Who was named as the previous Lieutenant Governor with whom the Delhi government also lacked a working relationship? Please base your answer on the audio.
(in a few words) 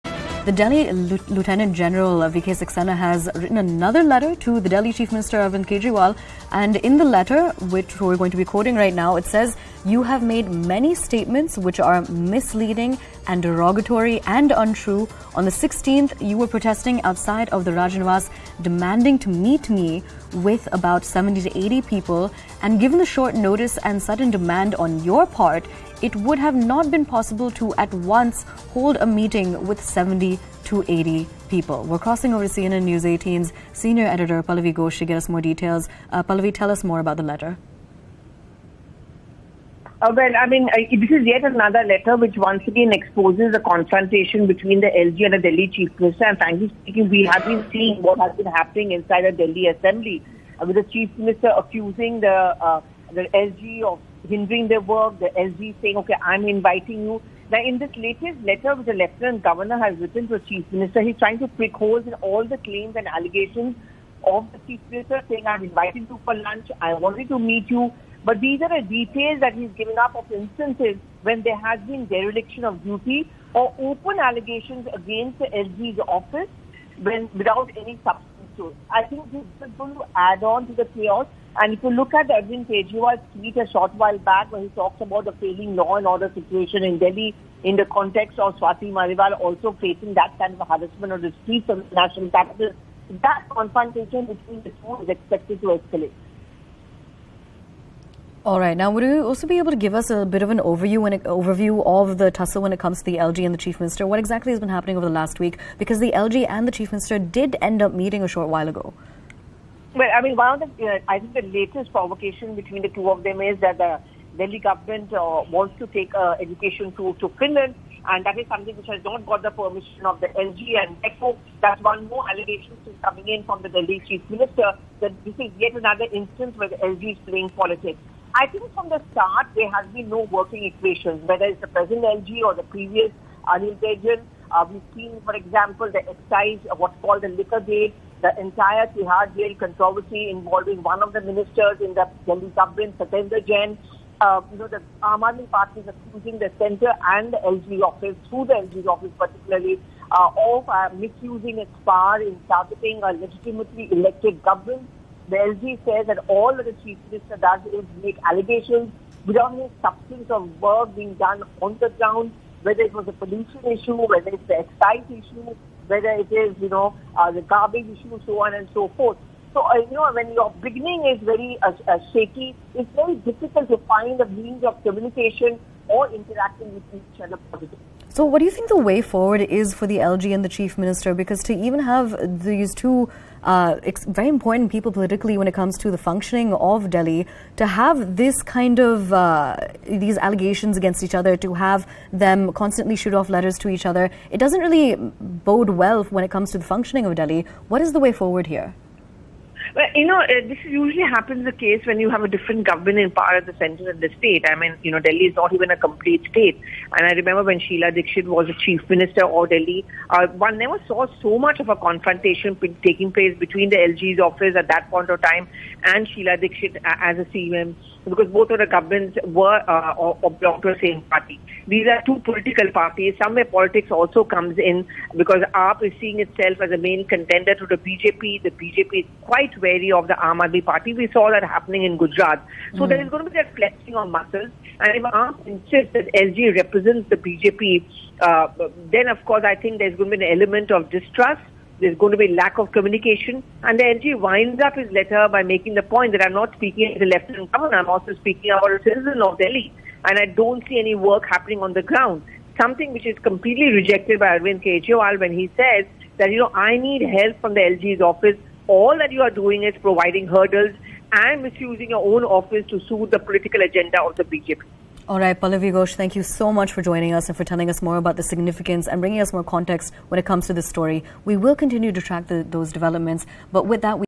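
Anil Baijal.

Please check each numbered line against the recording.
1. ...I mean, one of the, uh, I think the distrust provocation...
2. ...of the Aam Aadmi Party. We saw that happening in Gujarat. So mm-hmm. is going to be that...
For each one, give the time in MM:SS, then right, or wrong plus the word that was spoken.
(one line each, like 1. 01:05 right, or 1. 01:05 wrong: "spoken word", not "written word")
1. 01:50 wrong: "latest", not "distrust"
2. 03:49 right.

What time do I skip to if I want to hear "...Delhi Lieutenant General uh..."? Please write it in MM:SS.
00:00.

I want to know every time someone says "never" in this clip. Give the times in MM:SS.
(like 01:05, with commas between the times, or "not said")
03:30.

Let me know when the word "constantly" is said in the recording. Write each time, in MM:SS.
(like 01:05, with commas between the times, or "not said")
03:12.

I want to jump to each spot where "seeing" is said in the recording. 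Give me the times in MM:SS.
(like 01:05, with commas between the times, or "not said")
00:47, 03:45.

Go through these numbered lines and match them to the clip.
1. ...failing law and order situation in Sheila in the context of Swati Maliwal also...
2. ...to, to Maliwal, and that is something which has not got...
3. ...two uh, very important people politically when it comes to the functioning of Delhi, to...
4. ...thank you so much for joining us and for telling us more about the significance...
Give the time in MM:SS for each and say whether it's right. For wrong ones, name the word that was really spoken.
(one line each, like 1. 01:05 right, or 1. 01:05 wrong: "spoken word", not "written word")
1. 01:25 wrong: "Delhi", not "Sheila"
2. 01:56 wrong: "Finland", not "Maliwal"
3. 03:02 right
4. 04:25 right.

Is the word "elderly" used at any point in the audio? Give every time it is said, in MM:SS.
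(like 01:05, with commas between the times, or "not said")
not said.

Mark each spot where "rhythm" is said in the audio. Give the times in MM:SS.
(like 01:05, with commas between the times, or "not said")
not said.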